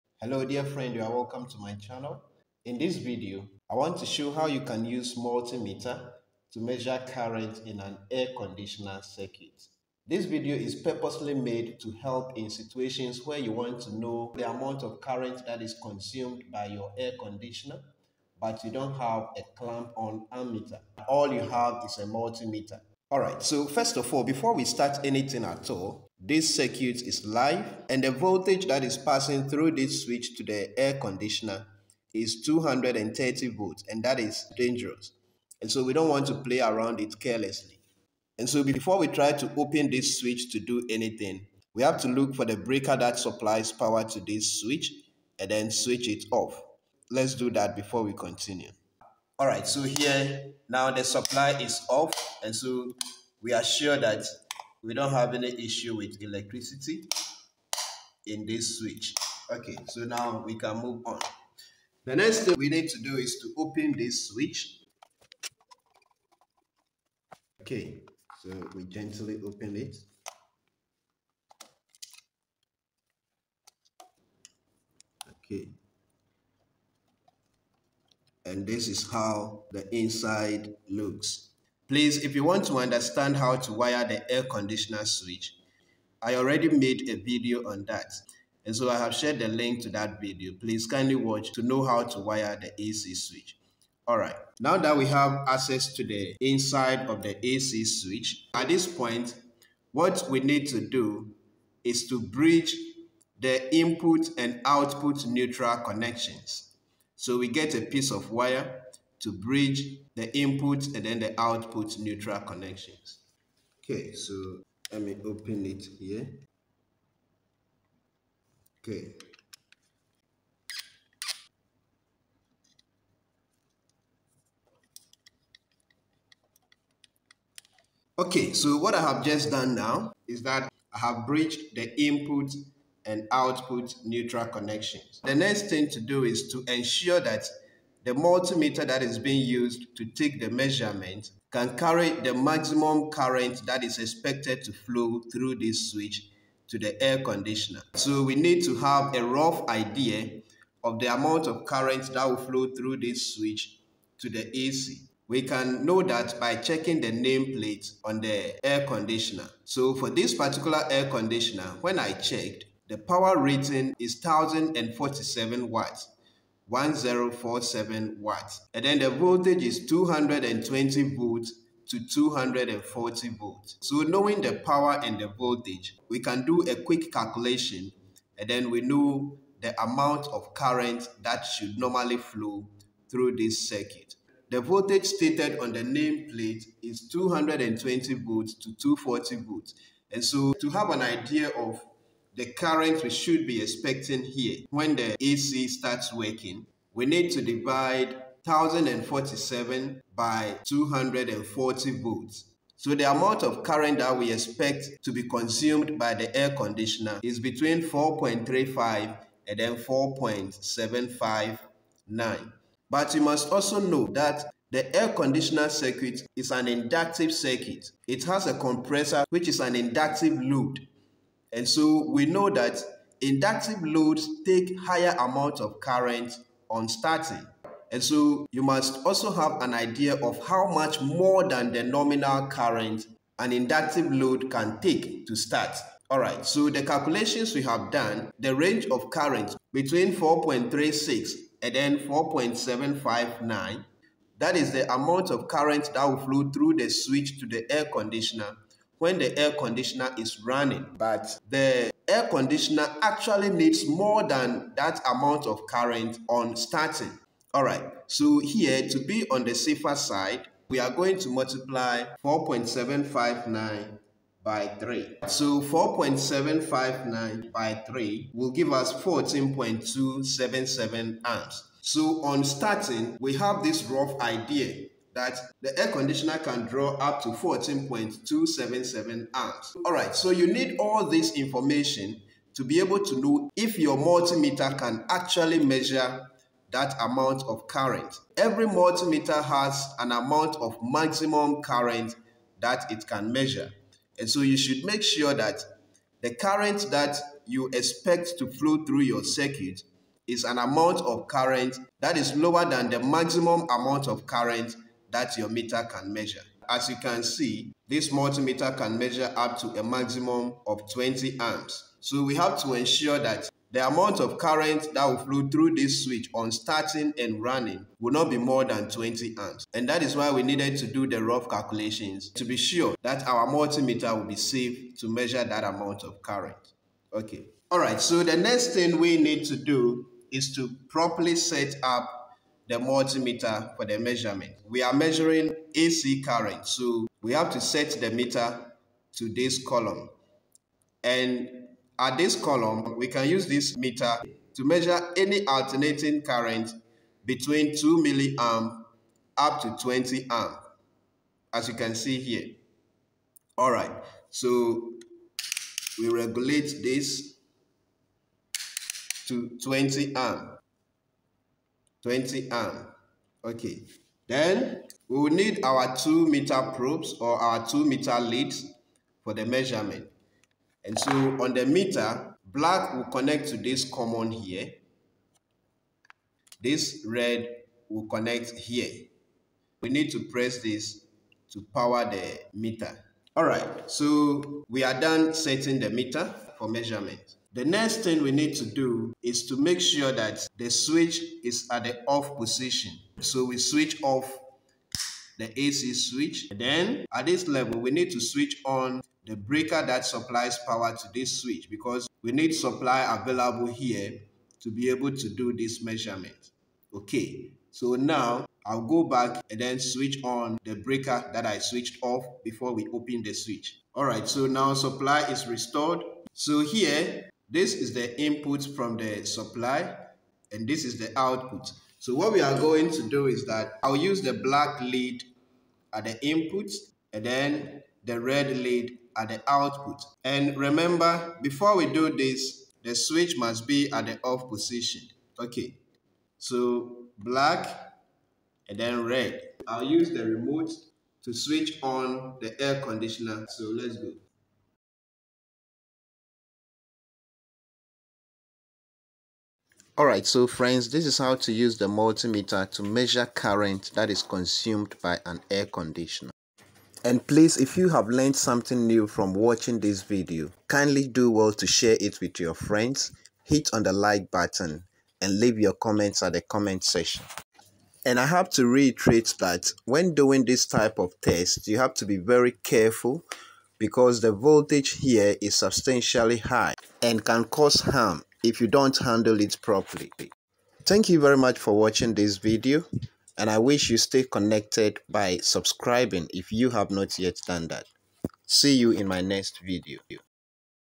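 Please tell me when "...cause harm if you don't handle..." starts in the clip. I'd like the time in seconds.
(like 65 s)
477 s.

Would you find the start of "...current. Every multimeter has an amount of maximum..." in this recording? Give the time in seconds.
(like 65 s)
287 s.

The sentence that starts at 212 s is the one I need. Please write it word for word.
But you must also know that the air conditioner circuit is an inductive circuit.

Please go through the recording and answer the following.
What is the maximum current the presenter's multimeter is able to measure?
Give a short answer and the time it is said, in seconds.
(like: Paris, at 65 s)
20 amps, at 309 s.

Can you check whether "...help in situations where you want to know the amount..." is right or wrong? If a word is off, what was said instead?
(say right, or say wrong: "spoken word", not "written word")
right.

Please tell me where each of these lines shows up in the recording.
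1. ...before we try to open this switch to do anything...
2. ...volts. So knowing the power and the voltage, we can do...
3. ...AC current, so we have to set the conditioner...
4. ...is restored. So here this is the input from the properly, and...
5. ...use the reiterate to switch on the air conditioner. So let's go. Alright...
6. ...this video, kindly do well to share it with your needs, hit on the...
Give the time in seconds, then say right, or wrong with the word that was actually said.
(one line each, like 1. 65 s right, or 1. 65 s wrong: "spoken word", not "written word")
1. 38 s right
2. 173 s right
3. 335 s wrong: "meter", not "conditioner"
4. 415 s wrong: "supply", not "properly"
5. 439 s wrong: "remote", not "reiterate"
6. 459 s wrong: "friends", not "needs".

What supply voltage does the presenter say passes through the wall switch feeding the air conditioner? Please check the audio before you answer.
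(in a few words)
230 volts.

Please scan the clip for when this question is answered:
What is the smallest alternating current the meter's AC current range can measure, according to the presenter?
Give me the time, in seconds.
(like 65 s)
347 s.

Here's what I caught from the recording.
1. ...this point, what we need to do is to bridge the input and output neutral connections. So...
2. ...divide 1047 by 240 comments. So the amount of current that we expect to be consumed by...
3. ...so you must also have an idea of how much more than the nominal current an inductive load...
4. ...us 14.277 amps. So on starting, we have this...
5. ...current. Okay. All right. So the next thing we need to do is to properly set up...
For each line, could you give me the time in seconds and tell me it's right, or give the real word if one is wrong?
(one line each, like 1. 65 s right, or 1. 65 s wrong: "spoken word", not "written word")
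1. 98 s right
2. 197 s wrong: "volts", not "comments"
3. 228 s right
4. 268 s right
5. 326 s right.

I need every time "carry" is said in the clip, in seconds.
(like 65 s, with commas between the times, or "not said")
141 s.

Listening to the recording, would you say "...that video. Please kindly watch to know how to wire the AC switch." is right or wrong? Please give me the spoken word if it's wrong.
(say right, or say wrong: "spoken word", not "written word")
right.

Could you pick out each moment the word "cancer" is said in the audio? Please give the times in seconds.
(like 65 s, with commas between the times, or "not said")
not said.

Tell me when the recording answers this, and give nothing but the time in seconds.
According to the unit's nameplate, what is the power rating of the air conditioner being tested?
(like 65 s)
162 s.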